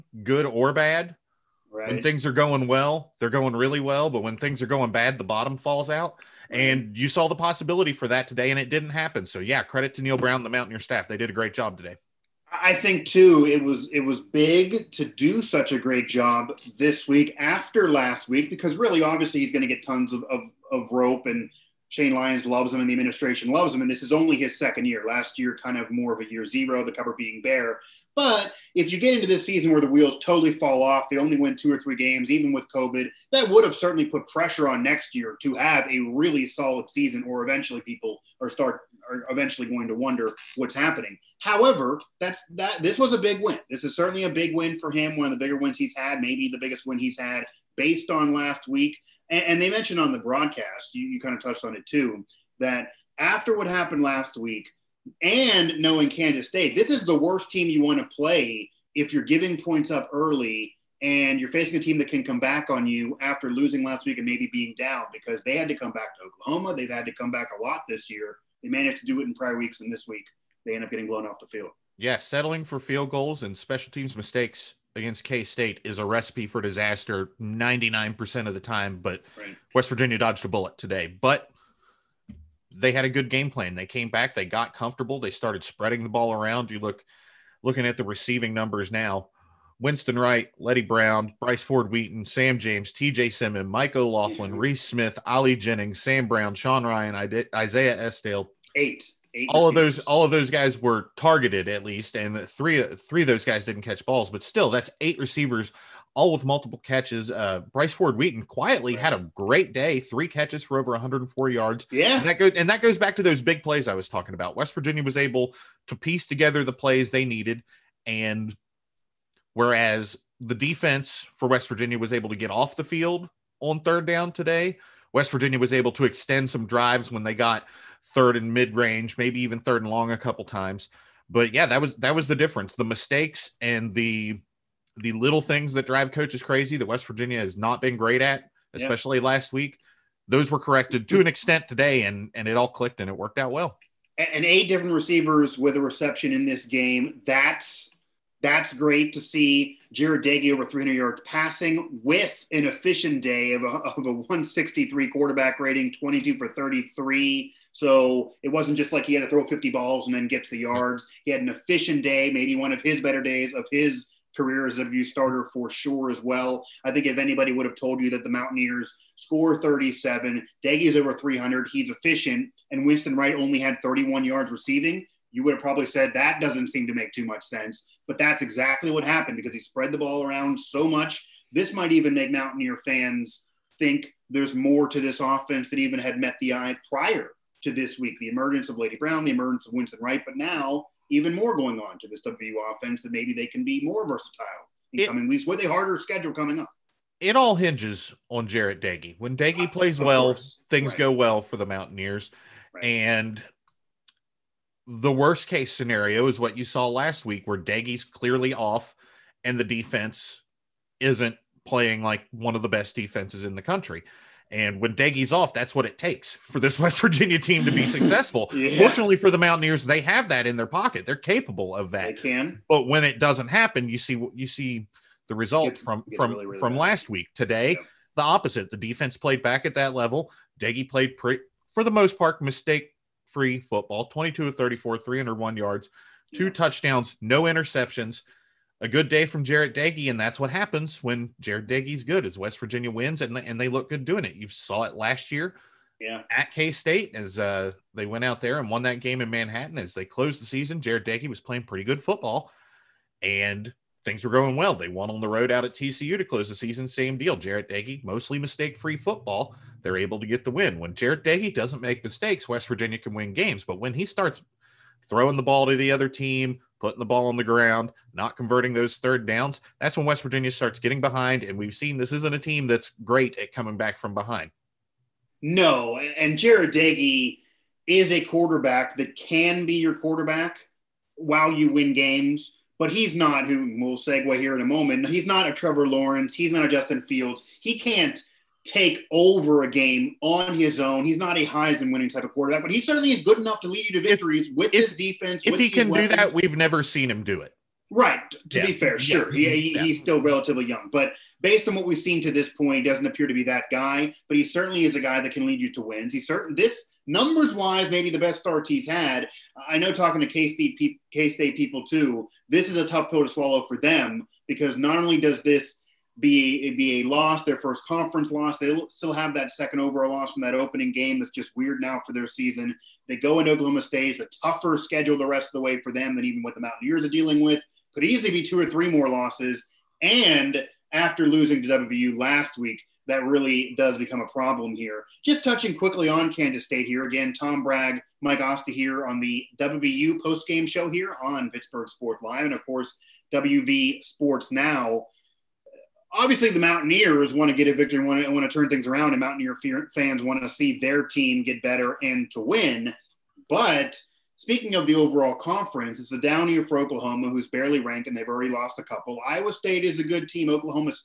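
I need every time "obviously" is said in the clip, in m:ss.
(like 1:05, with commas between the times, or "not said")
0:19, 5:46.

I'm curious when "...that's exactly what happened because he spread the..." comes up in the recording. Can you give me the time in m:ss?
2:58.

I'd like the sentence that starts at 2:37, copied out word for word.
So it wasn't just like he had to throw 50 balls and then get to the yards.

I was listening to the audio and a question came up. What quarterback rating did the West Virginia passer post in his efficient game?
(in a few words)
163.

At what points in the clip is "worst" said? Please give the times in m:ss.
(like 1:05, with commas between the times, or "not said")
0:57, 3:25.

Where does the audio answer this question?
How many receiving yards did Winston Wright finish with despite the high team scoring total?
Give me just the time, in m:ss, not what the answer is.
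2:53.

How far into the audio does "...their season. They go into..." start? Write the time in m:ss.
5:22.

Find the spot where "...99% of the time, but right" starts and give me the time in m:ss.
1:17.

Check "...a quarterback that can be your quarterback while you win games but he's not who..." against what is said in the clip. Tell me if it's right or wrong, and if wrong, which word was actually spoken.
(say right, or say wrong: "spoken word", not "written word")
right.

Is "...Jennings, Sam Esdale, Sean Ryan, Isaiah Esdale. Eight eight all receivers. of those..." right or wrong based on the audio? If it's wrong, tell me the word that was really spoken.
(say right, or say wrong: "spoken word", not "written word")
wrong: "Brown", not "Esdale".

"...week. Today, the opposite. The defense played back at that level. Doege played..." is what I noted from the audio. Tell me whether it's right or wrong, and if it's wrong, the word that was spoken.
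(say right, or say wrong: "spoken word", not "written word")
right.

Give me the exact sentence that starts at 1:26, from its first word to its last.
You look looking at the receiving numbers now.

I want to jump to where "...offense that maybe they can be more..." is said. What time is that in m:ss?
3:12.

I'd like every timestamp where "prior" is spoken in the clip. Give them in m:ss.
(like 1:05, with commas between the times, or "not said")
1:09, 3:06.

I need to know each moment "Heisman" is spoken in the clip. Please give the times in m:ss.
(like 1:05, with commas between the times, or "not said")
4:51.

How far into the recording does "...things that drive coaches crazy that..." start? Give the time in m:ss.
2:15.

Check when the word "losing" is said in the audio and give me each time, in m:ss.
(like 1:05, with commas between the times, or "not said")
1:03, 5:31.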